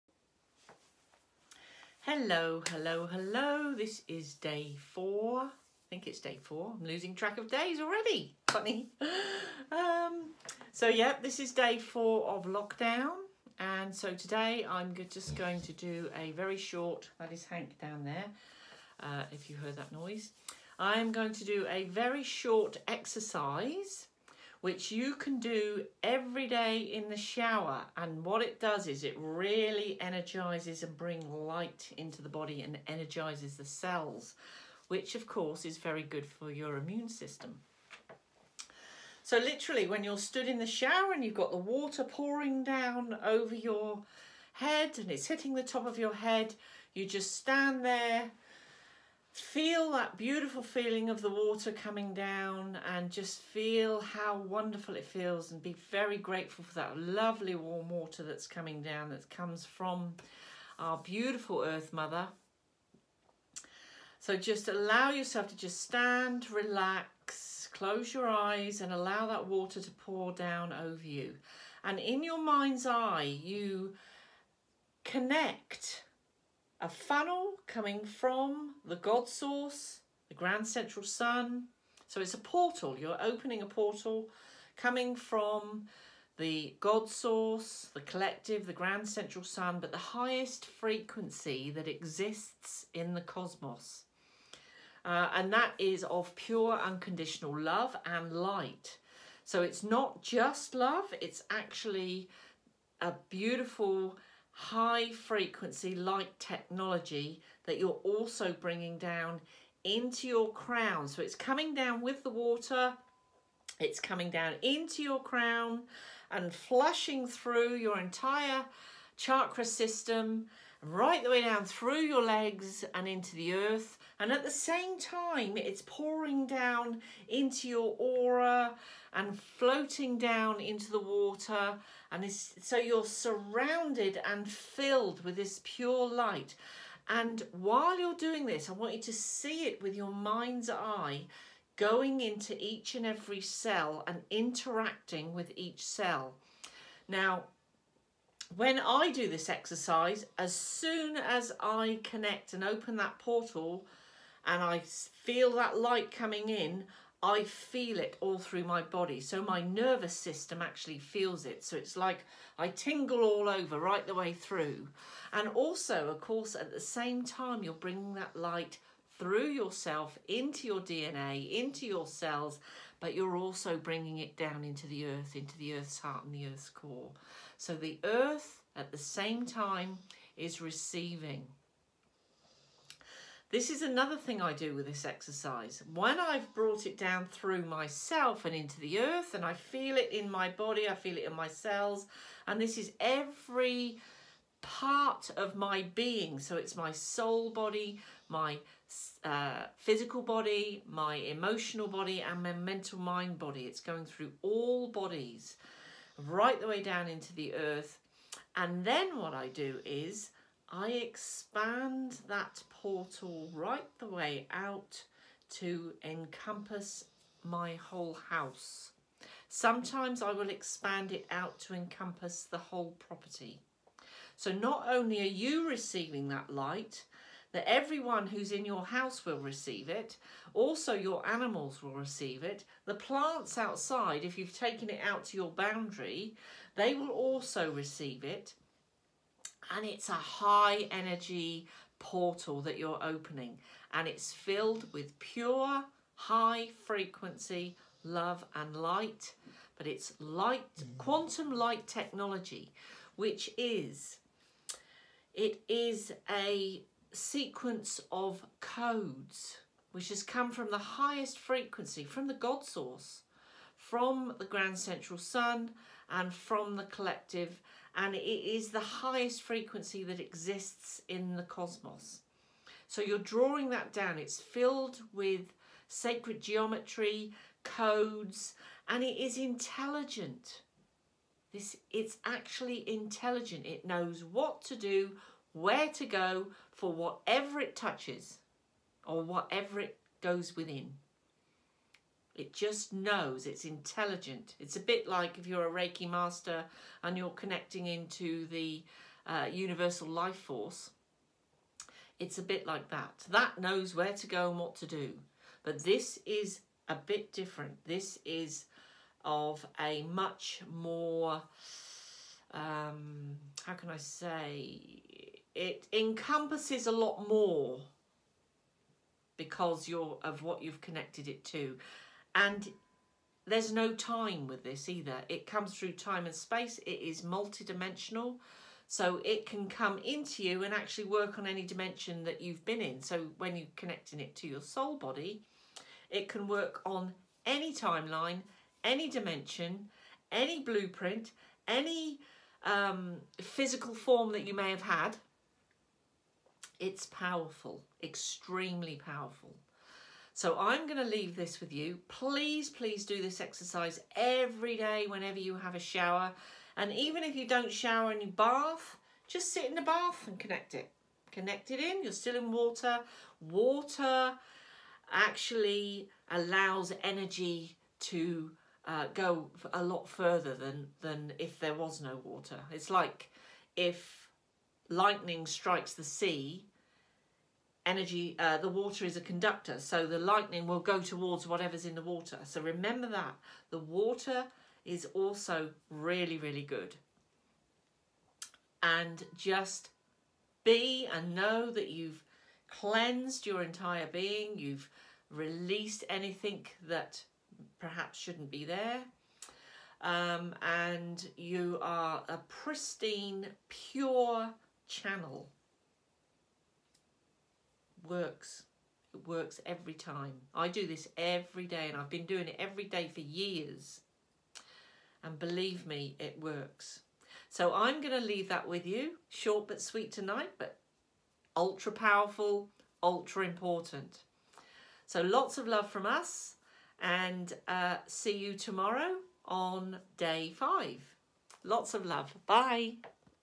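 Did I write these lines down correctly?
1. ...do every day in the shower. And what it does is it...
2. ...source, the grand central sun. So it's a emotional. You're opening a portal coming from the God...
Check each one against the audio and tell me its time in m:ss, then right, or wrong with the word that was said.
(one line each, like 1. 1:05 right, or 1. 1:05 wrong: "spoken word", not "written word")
1. 0:25 right
2. 1:19 wrong: "portal", not "emotional".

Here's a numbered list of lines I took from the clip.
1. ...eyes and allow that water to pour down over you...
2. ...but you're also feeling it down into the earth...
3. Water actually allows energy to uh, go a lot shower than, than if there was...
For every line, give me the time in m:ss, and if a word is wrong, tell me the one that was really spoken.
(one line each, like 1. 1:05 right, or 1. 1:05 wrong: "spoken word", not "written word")
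1. 1:08 right
2. 2:53 wrong: "bringing", not "feeling"
3. 6:03 wrong: "further", not "shower".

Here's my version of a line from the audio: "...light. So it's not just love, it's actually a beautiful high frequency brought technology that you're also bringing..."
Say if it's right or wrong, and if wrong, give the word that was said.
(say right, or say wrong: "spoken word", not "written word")
wrong: "light", not "brought".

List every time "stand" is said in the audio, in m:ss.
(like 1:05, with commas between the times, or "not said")
0:47, 1:05.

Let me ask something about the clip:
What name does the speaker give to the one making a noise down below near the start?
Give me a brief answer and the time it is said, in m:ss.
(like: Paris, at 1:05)
Hank, at 0:17.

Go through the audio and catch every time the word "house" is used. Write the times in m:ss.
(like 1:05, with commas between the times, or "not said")
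3:38, 3:48.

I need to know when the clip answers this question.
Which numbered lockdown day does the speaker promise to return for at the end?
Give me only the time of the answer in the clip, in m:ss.
7:10.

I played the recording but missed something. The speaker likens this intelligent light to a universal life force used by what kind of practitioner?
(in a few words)
Reiki master.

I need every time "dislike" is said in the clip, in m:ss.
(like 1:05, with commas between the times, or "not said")
not said.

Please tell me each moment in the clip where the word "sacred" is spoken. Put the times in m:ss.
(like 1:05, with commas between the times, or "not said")
4:35.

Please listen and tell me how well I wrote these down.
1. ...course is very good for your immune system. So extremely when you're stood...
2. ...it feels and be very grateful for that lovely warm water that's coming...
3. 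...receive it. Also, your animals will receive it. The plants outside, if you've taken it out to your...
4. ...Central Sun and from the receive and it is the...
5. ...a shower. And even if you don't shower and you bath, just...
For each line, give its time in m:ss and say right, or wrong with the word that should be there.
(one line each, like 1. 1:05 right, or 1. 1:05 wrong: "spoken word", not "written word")
1. 0:35 wrong: "literally", not "extremely"
2. 0:54 right
3. 3:49 right
4. 4:24 wrong: "collective", not "receive"
5. 5:55 right.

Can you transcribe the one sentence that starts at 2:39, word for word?
So my nervous system actually feels it.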